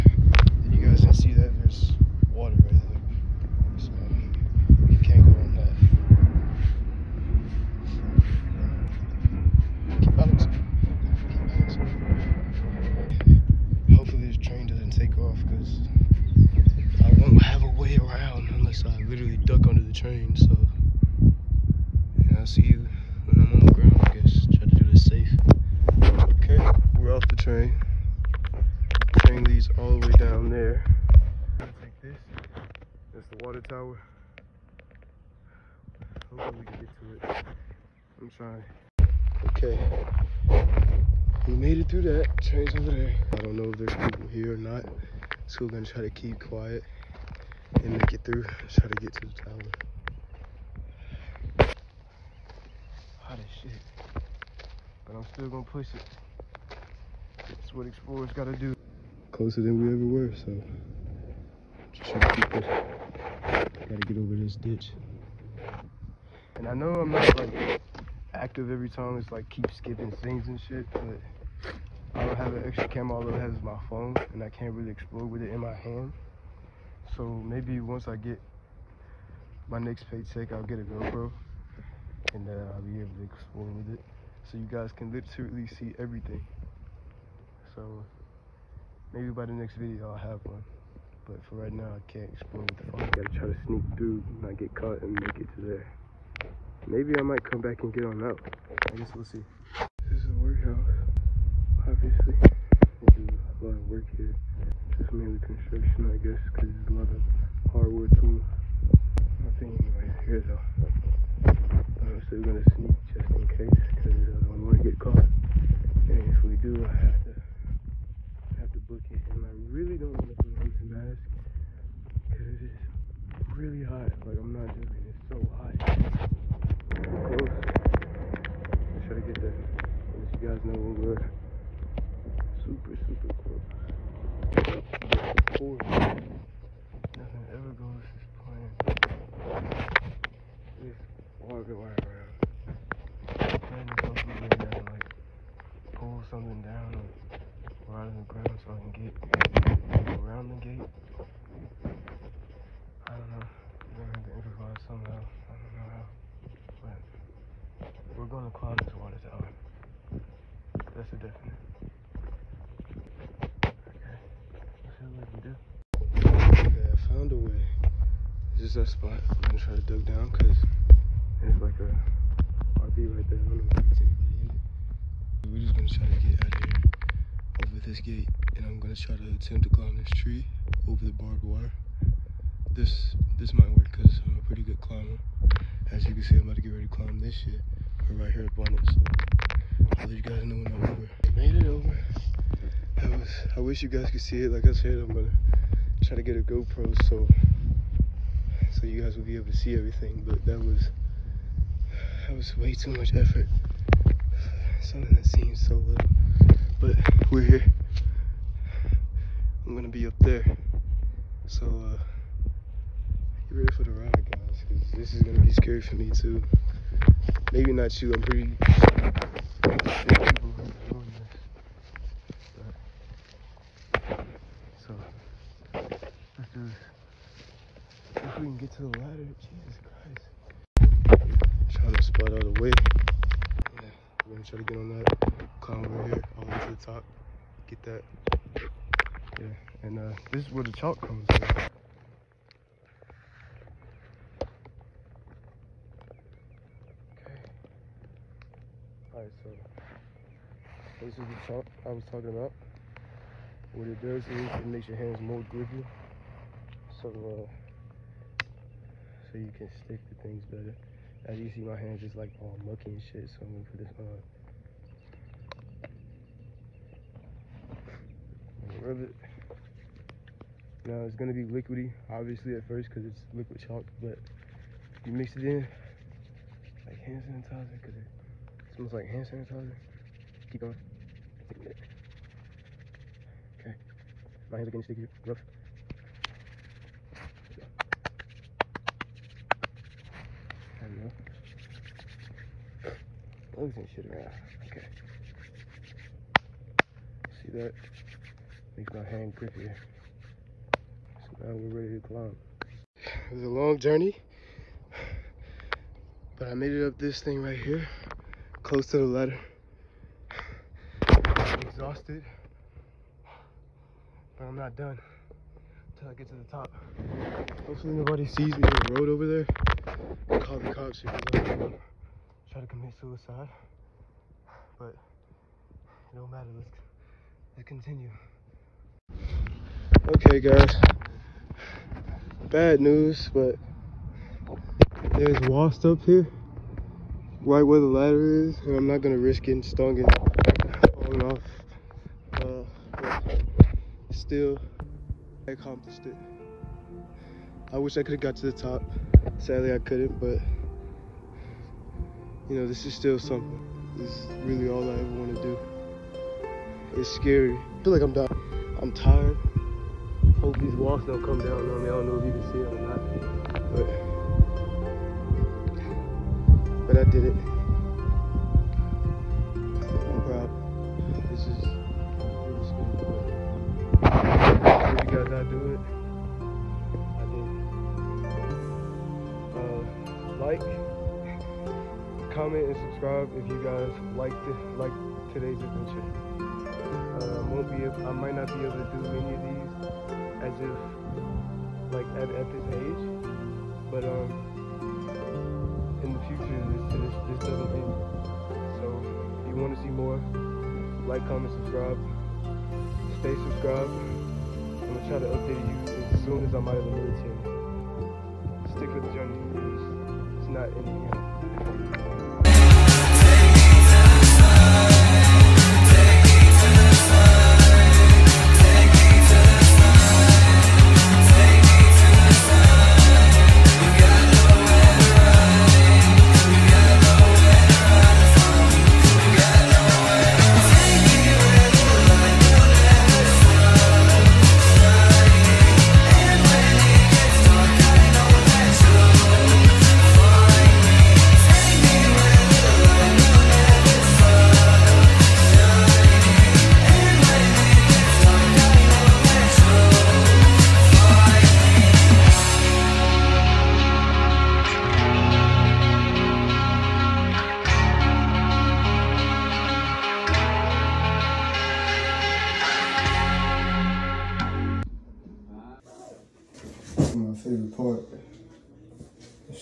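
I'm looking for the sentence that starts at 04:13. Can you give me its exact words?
What it does is it makes your hands more grippy.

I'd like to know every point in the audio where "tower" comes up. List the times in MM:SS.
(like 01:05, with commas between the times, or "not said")
00:33, 00:49.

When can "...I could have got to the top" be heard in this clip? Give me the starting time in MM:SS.
05:47.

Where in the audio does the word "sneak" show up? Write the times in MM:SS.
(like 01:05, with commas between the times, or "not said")
01:33, 01:52.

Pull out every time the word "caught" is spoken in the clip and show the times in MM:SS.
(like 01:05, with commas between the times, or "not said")
01:34, 01:54.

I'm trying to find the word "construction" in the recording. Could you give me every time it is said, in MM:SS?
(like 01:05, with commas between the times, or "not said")
01:45.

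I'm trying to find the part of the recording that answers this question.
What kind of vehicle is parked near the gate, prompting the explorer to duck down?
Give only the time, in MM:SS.
02:52.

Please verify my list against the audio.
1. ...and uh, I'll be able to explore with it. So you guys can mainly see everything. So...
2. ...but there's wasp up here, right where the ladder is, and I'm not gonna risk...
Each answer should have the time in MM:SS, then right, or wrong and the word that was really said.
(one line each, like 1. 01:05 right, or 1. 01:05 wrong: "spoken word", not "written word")
1. 01:22 wrong: "literally", not "mainly"
2. 05:33 right.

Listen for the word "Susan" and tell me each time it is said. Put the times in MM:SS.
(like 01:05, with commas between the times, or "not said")
not said.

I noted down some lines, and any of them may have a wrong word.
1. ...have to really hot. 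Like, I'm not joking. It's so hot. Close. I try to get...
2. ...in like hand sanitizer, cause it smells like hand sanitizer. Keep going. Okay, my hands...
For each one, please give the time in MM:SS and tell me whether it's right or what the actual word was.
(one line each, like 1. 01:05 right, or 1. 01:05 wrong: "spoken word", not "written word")
1. 01:57 right
2. 04:35 right.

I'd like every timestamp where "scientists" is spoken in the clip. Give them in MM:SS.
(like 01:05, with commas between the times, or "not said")
not said.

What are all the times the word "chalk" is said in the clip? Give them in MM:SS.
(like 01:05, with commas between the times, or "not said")
04:00, 04:11, 04:33.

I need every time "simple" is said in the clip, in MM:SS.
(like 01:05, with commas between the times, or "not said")
not said.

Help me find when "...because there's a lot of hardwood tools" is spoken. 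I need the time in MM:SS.
01:46.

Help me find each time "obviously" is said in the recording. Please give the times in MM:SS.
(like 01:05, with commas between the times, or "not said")
01:41, 04:32.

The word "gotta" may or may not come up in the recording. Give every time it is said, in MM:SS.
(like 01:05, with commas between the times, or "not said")
00:58, 01:03, 01:33.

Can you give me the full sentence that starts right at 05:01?
So now we're ready to climb.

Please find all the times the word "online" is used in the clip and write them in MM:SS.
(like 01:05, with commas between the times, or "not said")
not said.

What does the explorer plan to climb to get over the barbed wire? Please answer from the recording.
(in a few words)
tree.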